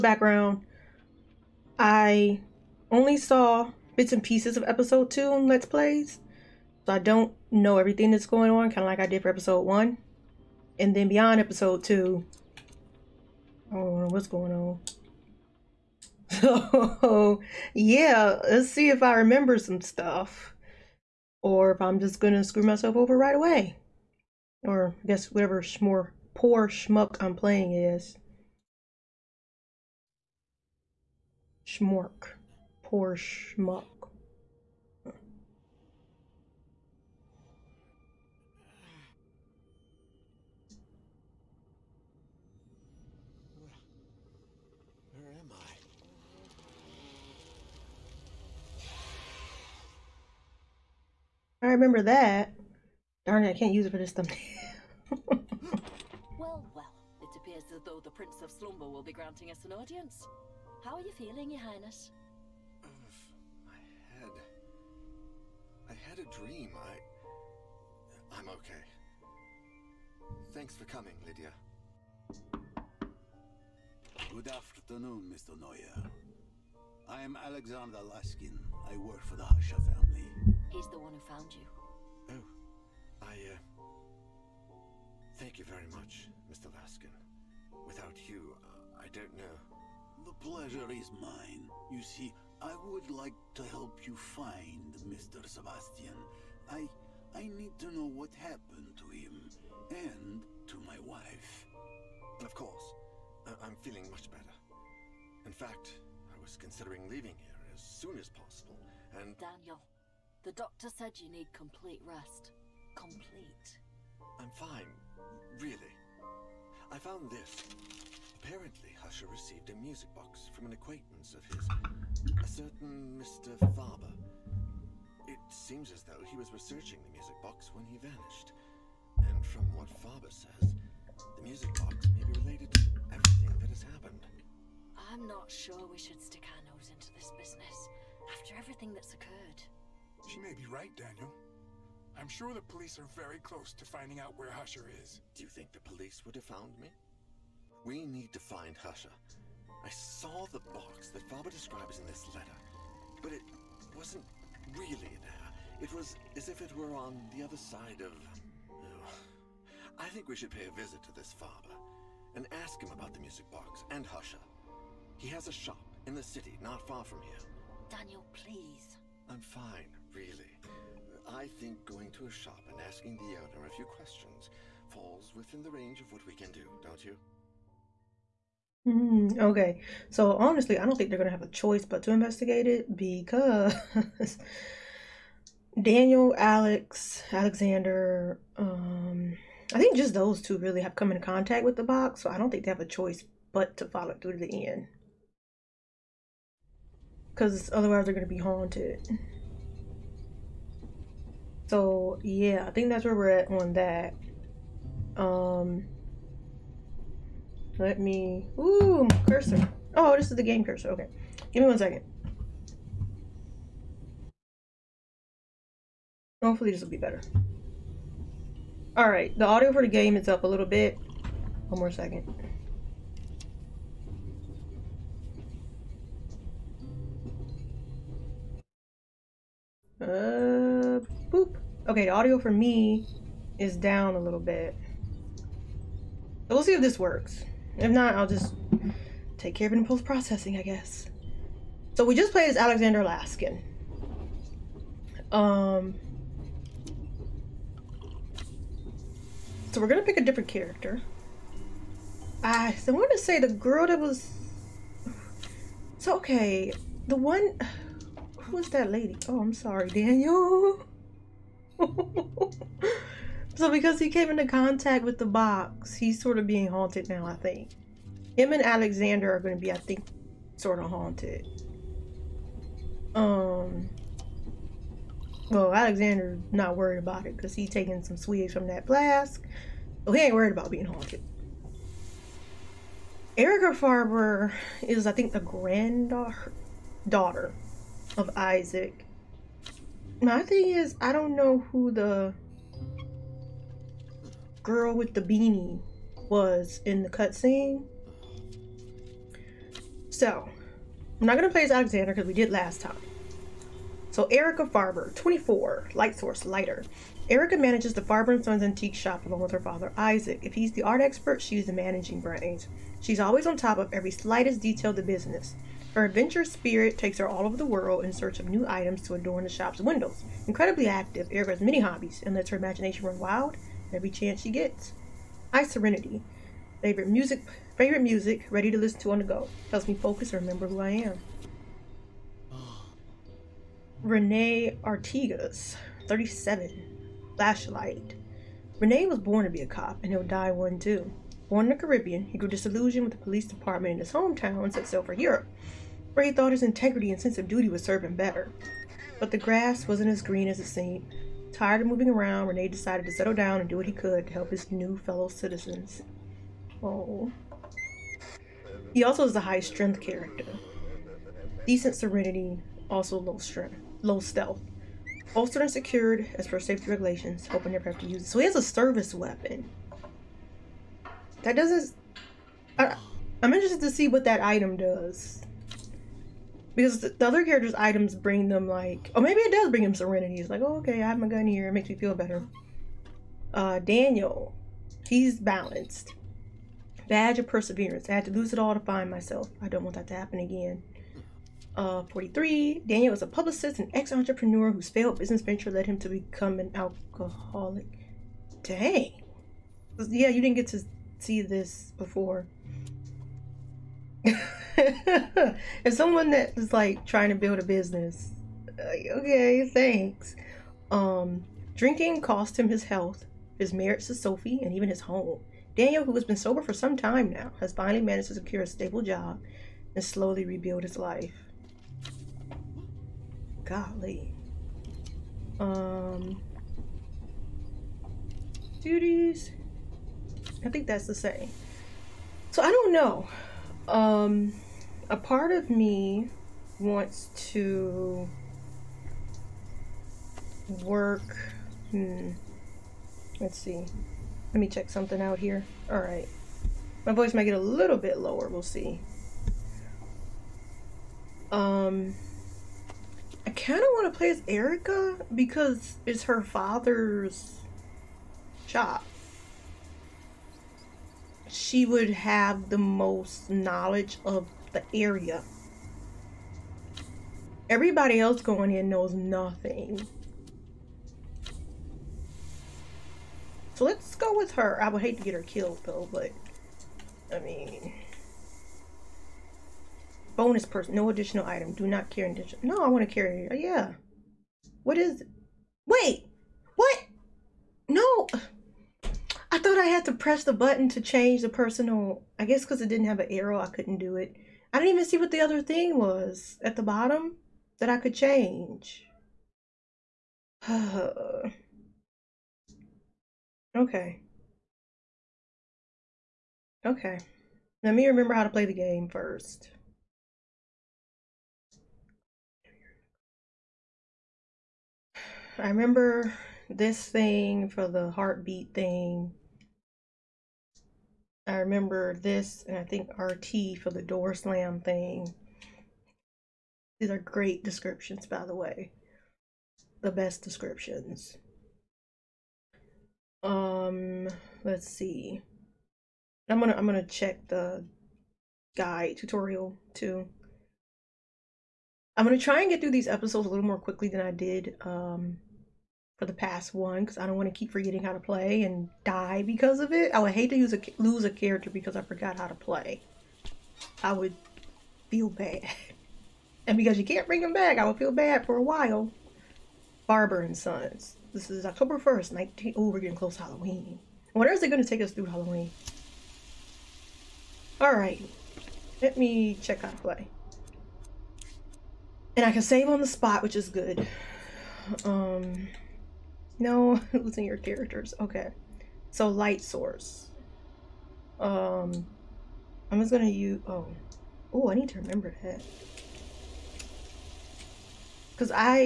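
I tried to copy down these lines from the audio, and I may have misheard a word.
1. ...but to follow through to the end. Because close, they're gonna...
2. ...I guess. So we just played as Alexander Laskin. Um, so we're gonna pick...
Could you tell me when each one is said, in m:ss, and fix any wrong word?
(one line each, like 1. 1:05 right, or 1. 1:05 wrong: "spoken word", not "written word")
1. 3:13 wrong: "otherwise", not "close"
2. 4:00 right.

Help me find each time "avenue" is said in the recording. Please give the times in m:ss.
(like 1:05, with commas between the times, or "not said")
not said.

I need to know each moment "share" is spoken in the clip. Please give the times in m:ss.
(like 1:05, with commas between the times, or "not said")
not said.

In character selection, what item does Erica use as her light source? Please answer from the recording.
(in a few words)
lighter.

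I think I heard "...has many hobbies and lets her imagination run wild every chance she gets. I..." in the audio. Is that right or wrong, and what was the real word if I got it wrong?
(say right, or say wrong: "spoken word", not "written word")
right.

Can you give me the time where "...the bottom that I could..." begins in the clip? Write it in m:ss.
8:16.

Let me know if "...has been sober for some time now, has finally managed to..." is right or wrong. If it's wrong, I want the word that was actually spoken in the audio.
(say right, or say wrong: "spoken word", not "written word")
right.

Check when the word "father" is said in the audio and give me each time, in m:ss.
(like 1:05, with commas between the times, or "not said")
5:09, 7:36.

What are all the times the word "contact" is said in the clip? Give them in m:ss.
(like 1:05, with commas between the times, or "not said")
3:11, 4:24.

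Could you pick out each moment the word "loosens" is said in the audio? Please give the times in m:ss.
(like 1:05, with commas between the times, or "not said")
not said.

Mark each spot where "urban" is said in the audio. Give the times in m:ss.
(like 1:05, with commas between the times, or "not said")
not said.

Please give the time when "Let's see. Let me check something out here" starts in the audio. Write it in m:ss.
7:23.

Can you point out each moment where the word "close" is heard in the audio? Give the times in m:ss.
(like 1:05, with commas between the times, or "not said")
2:23, 9:23.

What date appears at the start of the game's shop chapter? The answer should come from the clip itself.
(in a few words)
October 1st.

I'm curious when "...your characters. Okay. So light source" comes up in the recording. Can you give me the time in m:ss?
9:37.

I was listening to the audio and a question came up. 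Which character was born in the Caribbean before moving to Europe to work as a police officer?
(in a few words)
Renee Artigas.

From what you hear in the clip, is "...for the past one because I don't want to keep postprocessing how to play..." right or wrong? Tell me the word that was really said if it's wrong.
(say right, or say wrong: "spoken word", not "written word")
wrong: "forgetting", not "postprocessing".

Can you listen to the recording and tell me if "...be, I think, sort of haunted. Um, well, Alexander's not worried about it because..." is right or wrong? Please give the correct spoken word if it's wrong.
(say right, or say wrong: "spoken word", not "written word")
right.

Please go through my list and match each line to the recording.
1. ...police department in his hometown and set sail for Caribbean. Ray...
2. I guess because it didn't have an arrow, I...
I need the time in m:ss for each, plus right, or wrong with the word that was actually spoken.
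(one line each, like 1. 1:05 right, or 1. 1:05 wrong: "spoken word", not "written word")
1. 5:43 wrong: "Europe", not "Caribbean"
2. 8:12 right.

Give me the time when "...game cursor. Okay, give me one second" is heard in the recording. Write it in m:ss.
3:30.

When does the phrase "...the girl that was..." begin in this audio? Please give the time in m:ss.
4:13.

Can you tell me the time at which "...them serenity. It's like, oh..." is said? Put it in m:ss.
6:19.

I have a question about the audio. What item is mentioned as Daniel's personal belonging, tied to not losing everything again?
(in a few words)
Badge of perseverance.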